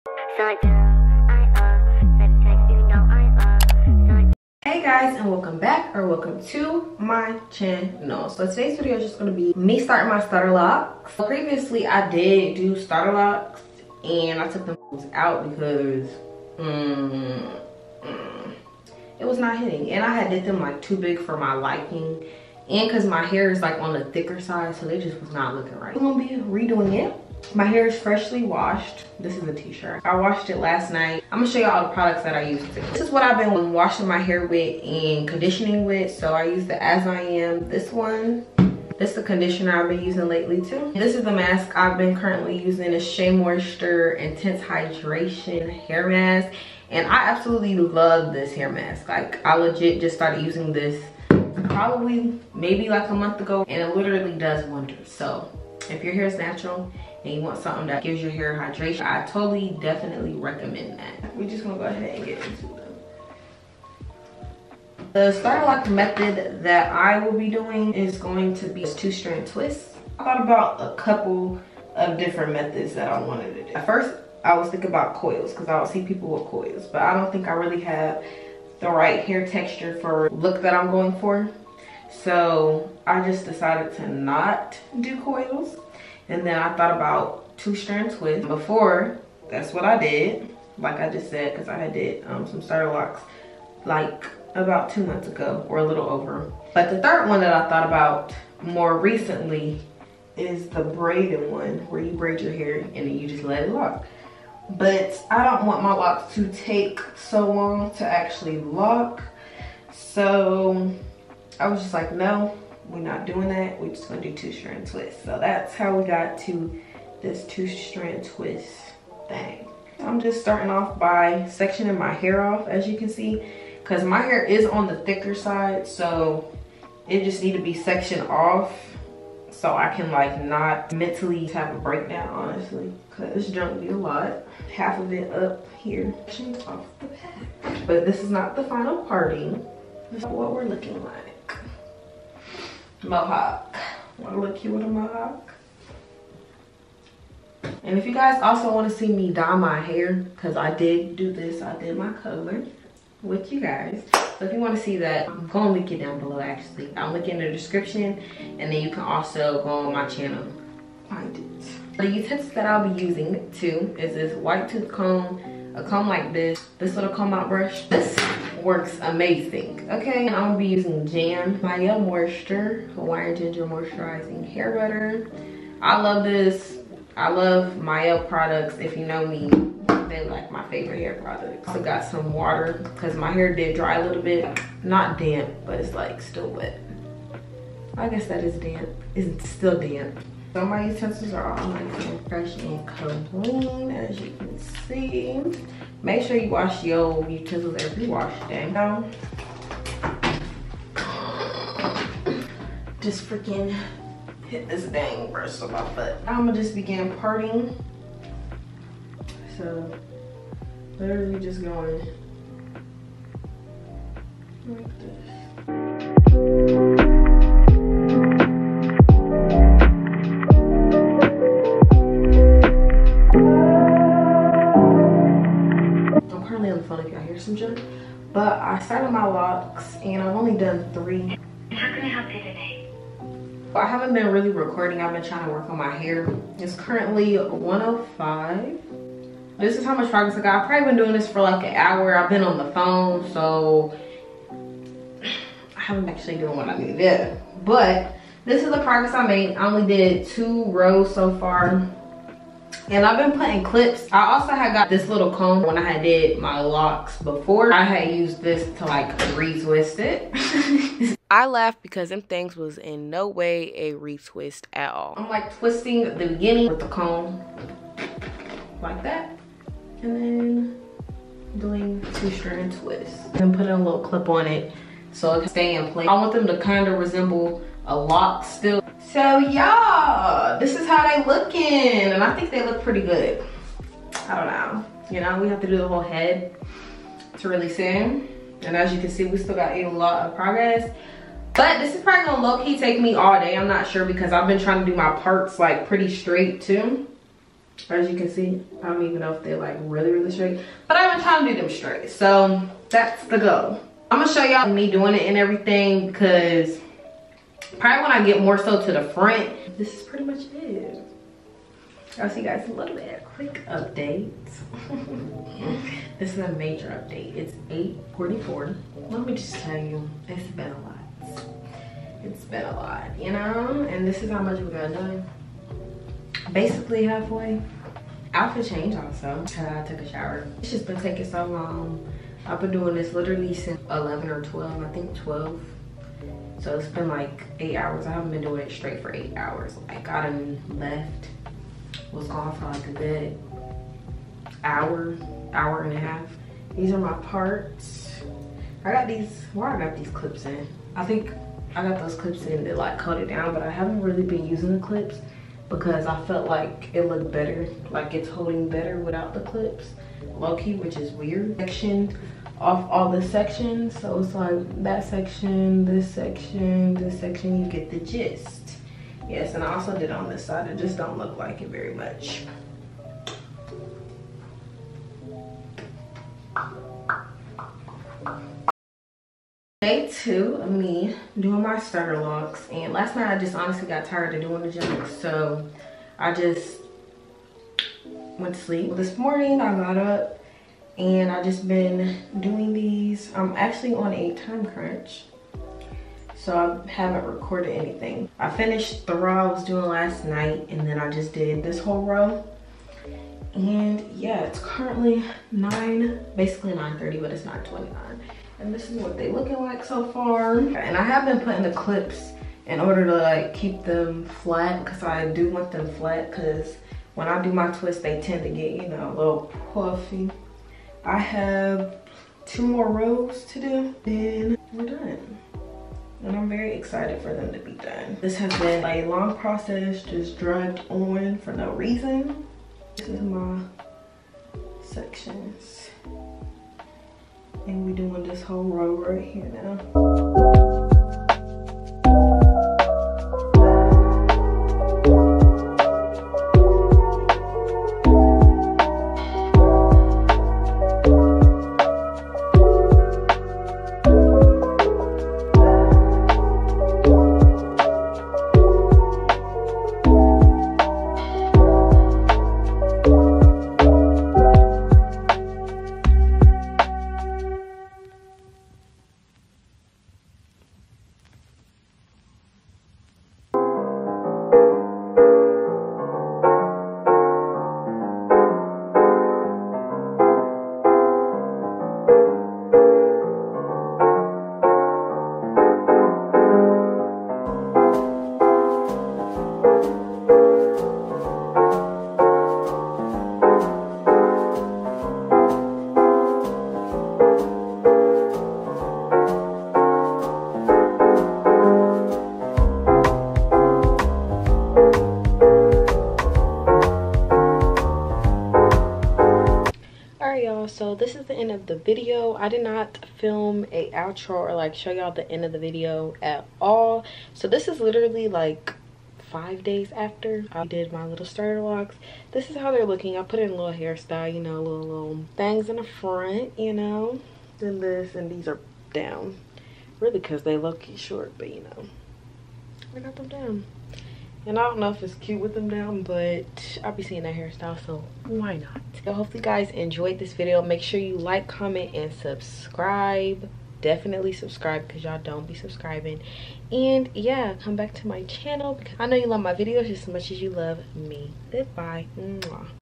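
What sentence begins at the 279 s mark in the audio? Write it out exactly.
So y'all, this is how they looking.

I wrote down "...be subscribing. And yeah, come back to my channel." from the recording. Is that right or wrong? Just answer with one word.
right.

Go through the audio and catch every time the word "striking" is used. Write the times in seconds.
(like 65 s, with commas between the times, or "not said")
not said.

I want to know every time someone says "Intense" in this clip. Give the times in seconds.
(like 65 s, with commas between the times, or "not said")
44 s.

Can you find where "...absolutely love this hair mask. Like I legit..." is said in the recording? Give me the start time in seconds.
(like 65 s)
47 s.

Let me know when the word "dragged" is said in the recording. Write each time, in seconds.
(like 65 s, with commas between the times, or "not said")
430 s.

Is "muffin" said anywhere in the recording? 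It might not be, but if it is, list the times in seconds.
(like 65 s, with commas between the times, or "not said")
not said.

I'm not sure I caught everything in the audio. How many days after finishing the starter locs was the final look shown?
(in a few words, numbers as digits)
Five days.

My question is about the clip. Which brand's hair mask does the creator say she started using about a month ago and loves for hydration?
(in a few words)
Shea Moisture.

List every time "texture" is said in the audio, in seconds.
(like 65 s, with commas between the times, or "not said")
79 s.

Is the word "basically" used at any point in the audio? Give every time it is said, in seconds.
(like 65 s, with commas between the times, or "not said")
326 s, 406 s.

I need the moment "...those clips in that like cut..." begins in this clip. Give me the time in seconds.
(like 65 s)
351 s.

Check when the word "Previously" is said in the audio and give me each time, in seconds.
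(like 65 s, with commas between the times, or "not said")
11 s.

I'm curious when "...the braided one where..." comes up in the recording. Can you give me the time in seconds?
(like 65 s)
100 s.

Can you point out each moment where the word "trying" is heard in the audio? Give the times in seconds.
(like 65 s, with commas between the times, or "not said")
235 s, 294 s, 301 s.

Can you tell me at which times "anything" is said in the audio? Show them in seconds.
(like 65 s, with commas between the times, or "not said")
397 s.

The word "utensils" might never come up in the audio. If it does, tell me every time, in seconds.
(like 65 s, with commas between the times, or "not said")
162 s, 190 s, 197 s.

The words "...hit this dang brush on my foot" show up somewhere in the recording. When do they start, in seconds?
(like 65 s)
204 s.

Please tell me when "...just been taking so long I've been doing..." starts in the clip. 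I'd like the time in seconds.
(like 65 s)
330 s.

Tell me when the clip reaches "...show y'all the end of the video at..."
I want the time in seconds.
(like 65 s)
514 s.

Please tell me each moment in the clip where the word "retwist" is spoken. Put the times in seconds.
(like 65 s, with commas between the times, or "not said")
259 s, 263 s.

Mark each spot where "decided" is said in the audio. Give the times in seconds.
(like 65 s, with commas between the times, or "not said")
83 s.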